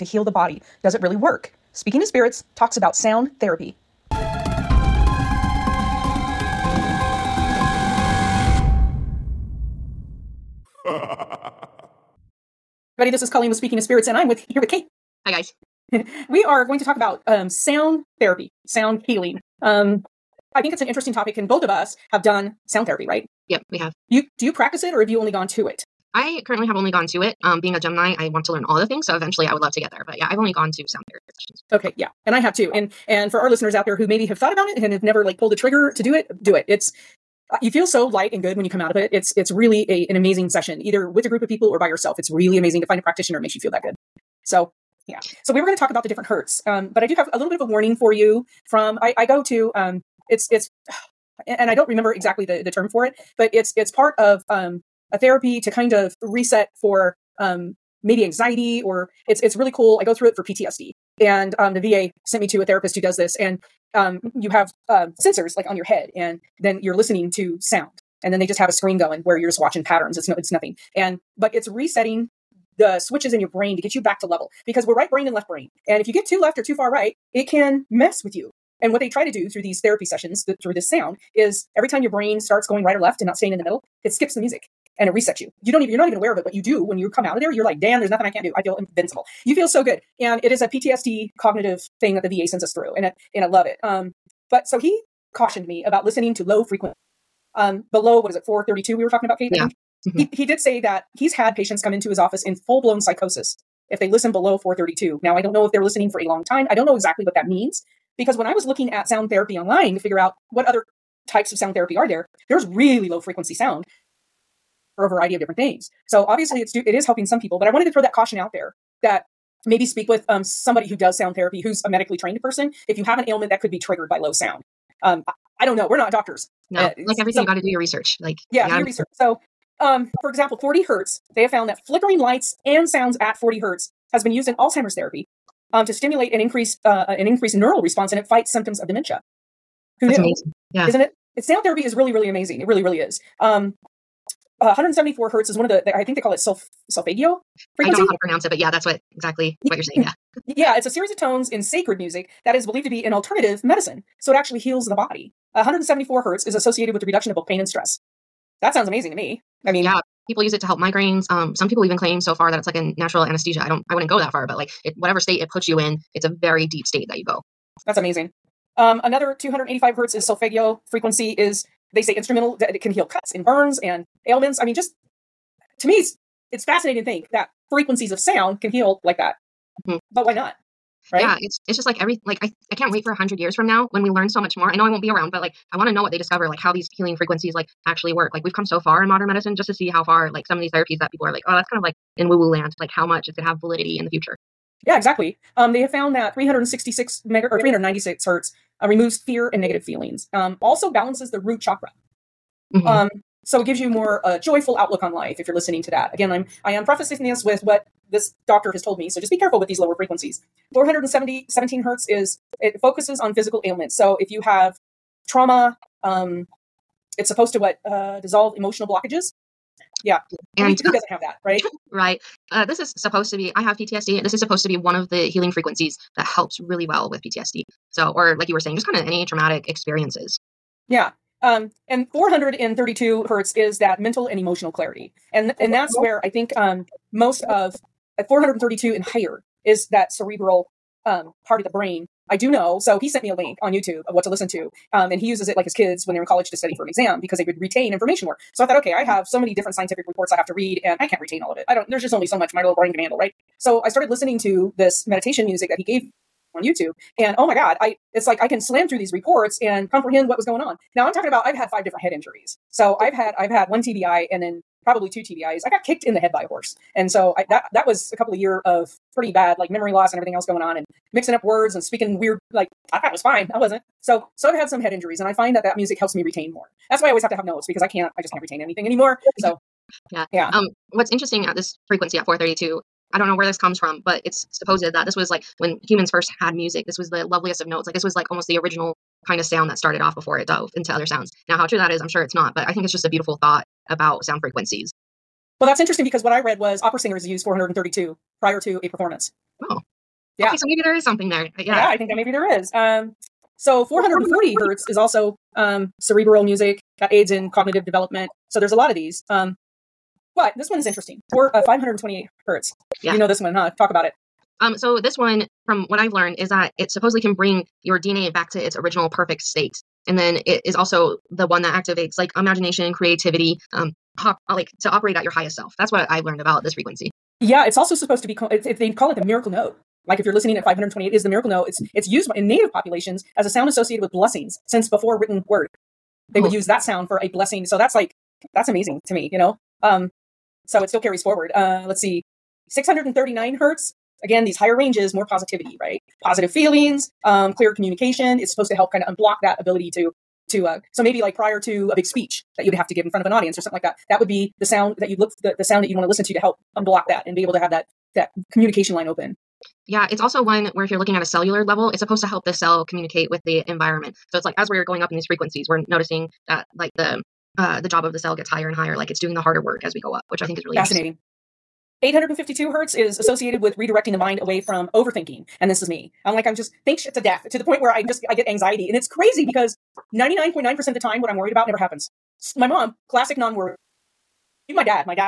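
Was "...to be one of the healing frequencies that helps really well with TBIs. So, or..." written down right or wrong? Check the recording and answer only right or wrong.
wrong.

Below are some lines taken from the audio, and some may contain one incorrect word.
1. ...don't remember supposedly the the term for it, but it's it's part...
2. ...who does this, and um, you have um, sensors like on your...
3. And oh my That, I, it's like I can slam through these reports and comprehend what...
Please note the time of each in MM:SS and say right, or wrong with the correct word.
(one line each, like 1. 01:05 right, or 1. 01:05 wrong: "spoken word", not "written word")
1. 00:51 wrong: "exactly", not "supposedly"
2. 01:02 right
3. 04:17 wrong: "God", not "That".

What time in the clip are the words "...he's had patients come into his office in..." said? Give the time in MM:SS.
01:41.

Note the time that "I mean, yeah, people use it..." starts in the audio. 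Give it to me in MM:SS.
02:39.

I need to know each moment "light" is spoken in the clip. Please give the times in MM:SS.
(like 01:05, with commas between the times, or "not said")
00:38, 02:12.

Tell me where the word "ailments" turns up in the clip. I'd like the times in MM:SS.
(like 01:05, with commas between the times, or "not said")
02:03, 02:54, 03:33.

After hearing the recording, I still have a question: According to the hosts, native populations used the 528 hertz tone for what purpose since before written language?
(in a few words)
blessings.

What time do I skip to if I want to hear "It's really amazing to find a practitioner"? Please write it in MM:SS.
00:42.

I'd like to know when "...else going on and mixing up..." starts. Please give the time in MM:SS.
04:30.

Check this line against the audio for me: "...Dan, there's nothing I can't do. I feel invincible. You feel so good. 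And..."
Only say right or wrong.
right.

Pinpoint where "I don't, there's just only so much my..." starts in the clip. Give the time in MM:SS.
04:11.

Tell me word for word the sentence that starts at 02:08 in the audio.
Like, yeah, you do your research.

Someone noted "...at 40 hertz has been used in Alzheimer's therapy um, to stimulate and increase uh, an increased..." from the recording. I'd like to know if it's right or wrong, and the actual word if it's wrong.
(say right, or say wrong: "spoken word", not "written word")
right.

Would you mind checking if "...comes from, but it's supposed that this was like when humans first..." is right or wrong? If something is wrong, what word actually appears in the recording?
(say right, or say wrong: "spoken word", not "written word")
right.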